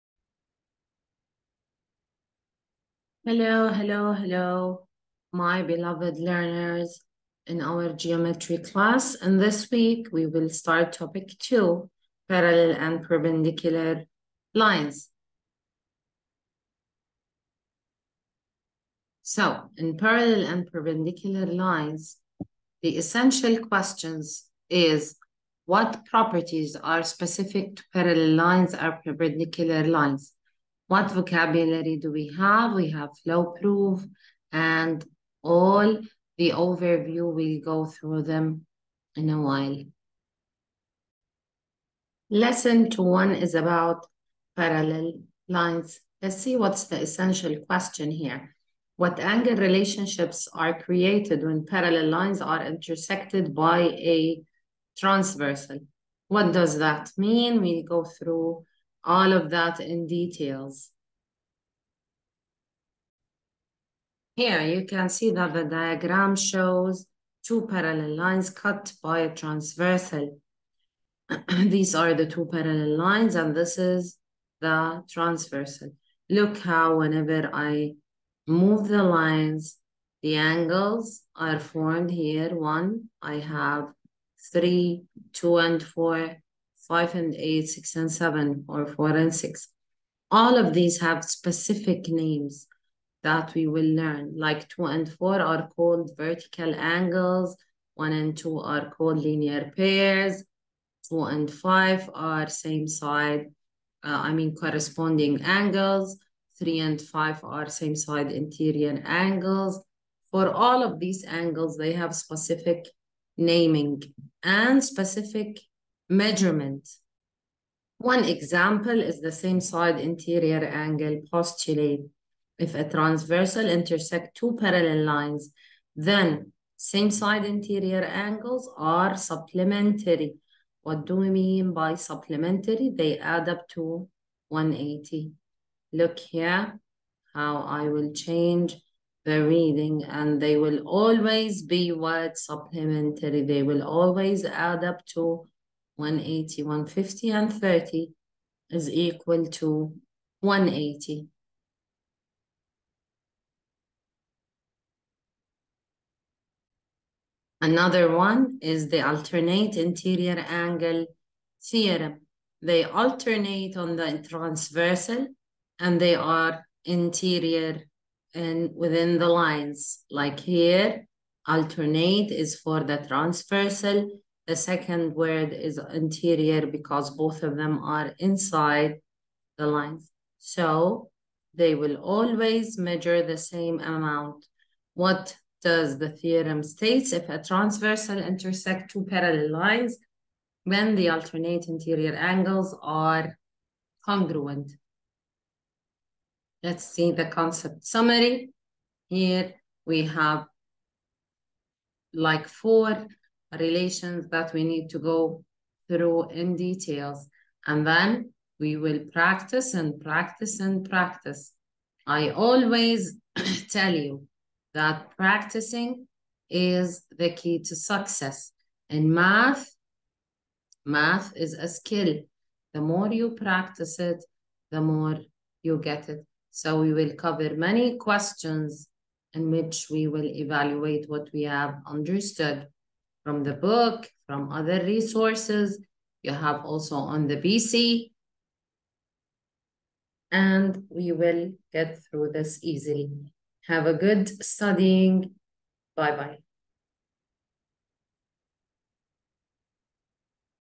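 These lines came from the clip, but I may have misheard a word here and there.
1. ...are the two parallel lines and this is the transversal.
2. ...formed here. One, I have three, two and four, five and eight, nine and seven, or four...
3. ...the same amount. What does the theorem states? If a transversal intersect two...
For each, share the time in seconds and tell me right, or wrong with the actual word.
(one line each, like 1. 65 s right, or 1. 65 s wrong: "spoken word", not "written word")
1. 71 s right
2. 81 s wrong: "six", not "nine"
3. 183 s right.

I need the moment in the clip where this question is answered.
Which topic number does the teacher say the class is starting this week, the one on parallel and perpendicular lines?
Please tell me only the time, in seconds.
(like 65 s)
10 s.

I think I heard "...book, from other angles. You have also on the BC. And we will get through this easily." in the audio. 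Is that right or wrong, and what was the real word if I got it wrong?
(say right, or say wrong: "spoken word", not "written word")
wrong: "resources", not "angles".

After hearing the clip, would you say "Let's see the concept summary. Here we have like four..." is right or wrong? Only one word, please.
right.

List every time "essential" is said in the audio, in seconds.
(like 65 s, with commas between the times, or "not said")
22 s, 47 s.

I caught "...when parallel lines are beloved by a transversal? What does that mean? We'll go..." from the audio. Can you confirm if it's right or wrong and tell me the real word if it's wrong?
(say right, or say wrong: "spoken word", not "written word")
wrong: "intersected", not "beloved".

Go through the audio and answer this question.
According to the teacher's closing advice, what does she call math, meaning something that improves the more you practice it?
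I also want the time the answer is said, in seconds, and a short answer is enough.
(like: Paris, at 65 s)
A skill, at 221 s.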